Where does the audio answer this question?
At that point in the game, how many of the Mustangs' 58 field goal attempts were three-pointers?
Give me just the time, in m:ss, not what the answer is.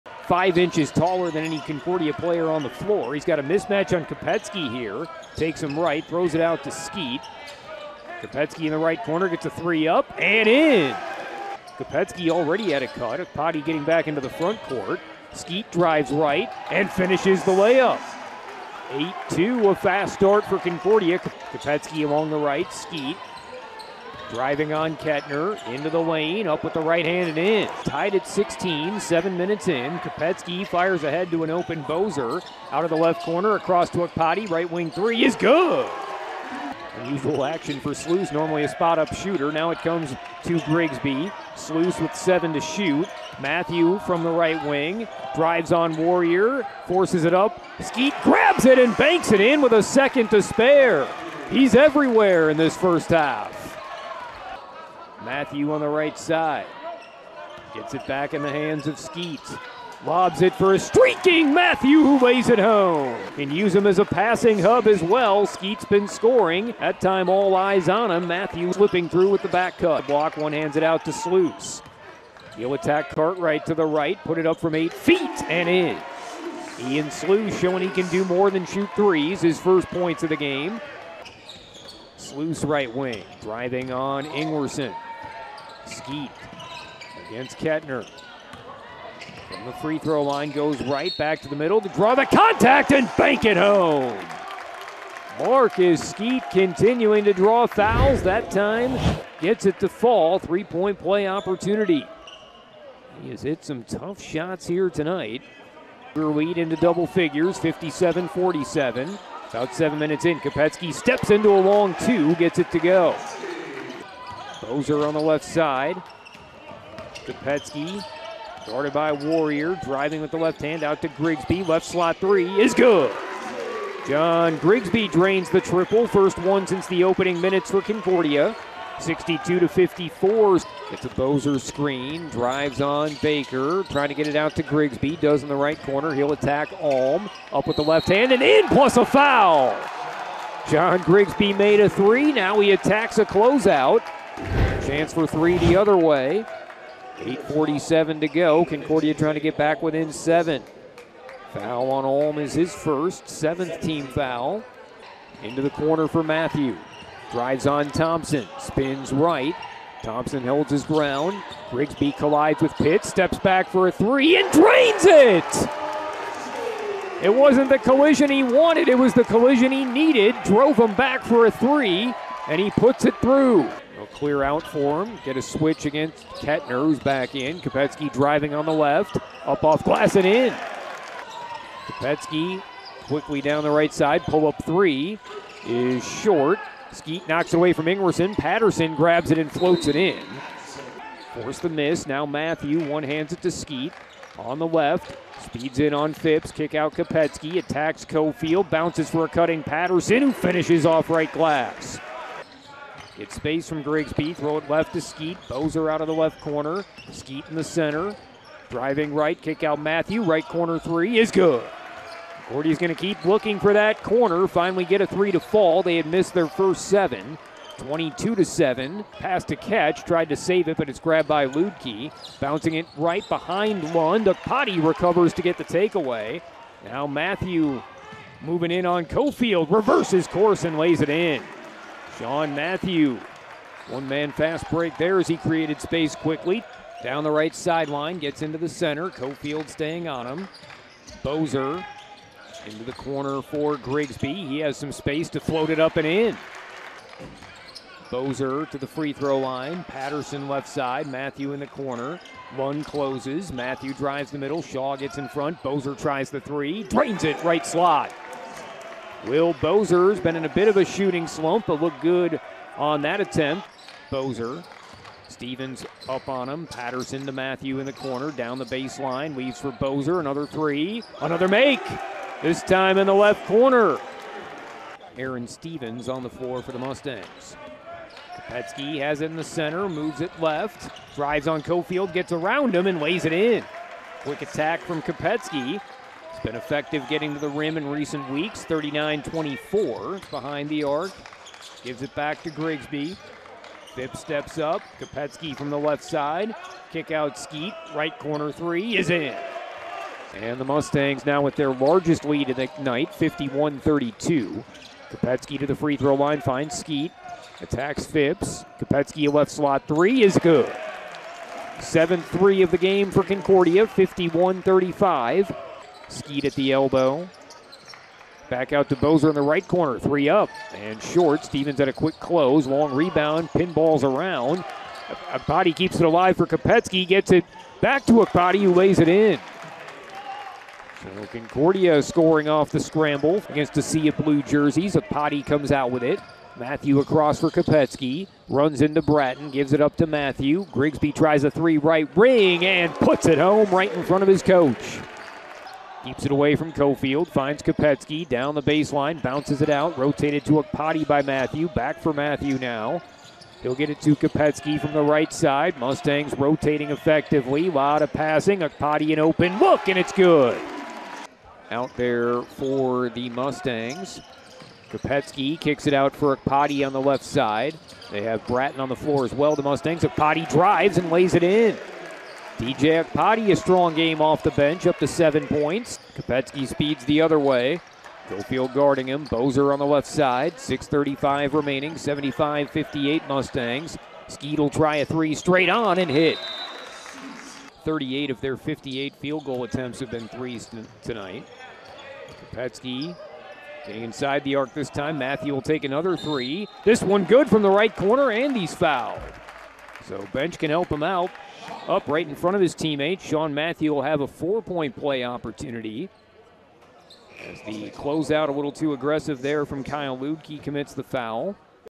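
6:27.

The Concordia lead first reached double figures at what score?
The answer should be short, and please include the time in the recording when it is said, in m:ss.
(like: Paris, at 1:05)
57-47, at 1:47.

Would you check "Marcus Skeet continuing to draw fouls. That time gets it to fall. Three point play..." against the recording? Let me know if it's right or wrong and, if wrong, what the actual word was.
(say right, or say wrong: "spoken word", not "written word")
right.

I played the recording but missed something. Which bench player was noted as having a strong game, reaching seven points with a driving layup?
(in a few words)
DJ Akpati.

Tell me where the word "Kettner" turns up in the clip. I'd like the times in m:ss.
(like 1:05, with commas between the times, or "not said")
0:24, 1:27, 2:56.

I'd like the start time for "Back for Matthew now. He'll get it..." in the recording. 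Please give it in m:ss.
5:51.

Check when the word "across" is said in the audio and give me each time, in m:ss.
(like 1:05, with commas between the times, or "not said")
0:33, 5:36.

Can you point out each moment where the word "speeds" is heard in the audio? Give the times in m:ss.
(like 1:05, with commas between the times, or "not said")
3:15, 6:16.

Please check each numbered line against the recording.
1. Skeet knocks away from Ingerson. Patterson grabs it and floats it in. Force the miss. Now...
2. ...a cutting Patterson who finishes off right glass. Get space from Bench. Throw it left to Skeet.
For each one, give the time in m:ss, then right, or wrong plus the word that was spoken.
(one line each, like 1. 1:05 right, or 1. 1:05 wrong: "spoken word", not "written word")
1. 3:06 right
2. 3:19 wrong: "Grigsby", not "Bench".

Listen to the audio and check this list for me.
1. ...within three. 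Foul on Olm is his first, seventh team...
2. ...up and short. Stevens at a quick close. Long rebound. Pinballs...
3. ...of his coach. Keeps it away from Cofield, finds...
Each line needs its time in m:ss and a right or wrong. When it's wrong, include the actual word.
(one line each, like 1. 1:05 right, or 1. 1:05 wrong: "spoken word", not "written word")
1. 2:29 wrong: "seven", not "three"
2. 5:20 right
3. 5:44 right.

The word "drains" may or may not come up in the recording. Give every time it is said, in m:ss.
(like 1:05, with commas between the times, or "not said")
2:05, 2:44, 4:16.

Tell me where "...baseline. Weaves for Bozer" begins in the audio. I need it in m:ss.
4:28.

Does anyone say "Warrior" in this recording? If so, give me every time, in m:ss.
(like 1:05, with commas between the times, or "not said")
0:45, 1:59.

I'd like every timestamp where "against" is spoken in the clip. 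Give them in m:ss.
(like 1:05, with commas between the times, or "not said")
1:27, 2:55, 5:33.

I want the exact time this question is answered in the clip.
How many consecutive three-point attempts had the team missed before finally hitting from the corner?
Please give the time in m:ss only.
3:35.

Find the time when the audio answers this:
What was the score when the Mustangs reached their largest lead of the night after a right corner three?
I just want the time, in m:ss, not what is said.
5:03.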